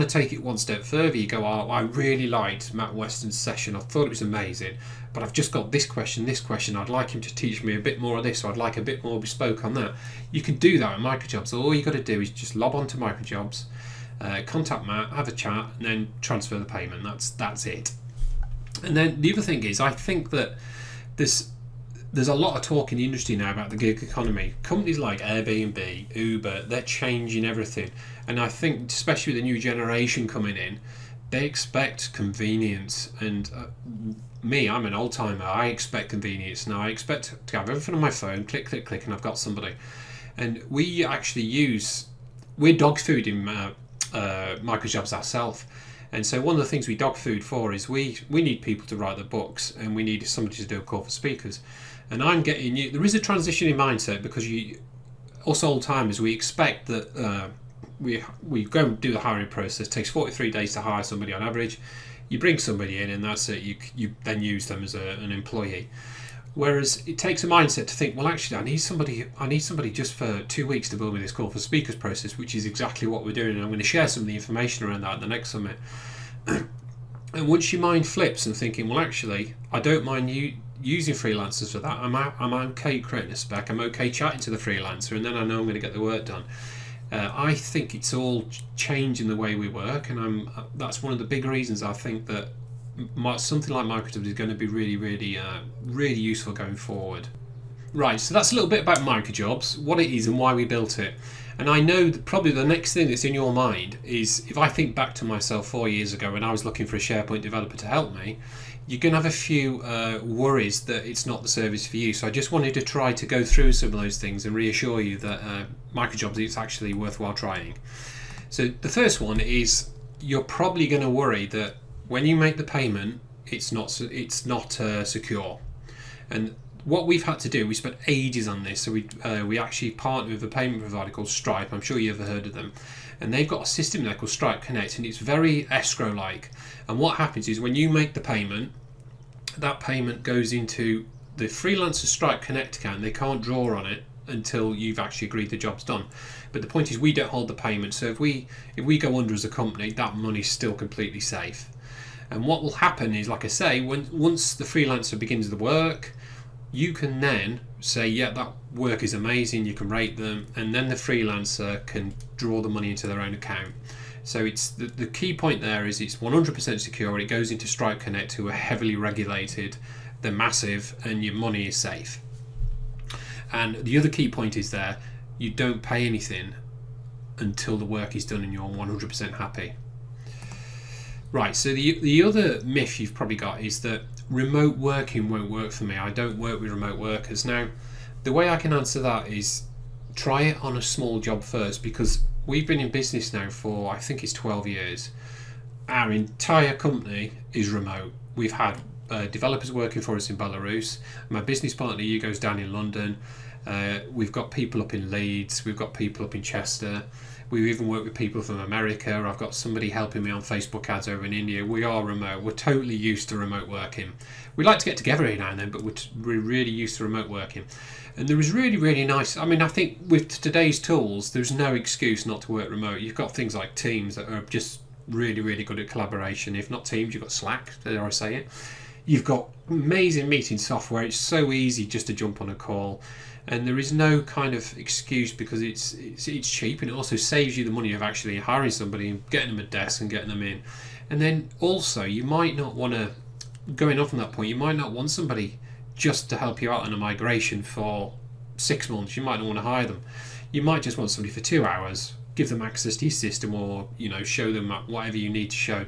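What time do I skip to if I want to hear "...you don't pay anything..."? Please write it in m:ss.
2:55.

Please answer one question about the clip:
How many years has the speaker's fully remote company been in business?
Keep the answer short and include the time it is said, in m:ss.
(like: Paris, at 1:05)
12, at 3:14.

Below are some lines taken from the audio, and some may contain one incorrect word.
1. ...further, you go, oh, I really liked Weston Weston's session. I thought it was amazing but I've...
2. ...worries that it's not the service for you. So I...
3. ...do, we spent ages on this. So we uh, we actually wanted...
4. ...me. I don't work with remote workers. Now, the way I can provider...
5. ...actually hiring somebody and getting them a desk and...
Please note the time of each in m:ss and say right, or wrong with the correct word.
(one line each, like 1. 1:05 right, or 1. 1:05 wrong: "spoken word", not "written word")
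1. 0:00 wrong: "Matt", not "Weston"
2. 1:50 right
3. 2:07 wrong: "partnered", not "wanted"
4. 3:05 wrong: "answer", not "provider"
5. 3:58 right.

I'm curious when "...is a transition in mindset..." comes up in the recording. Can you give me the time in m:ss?
0:53.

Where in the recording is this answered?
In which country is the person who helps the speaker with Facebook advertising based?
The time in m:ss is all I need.
3:31.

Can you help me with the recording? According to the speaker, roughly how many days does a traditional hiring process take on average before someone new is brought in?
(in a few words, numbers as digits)
43.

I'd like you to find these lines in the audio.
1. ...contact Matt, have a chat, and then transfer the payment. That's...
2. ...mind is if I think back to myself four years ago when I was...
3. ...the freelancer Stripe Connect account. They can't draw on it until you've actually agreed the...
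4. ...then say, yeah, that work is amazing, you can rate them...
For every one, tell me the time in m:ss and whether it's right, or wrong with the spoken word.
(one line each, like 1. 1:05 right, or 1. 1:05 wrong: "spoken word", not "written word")
1. 0:14 right
2. 1:43 right
3. 2:21 right
4. 2:37 right.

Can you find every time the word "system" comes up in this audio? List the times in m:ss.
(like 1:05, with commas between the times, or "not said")
2:13, 4:13.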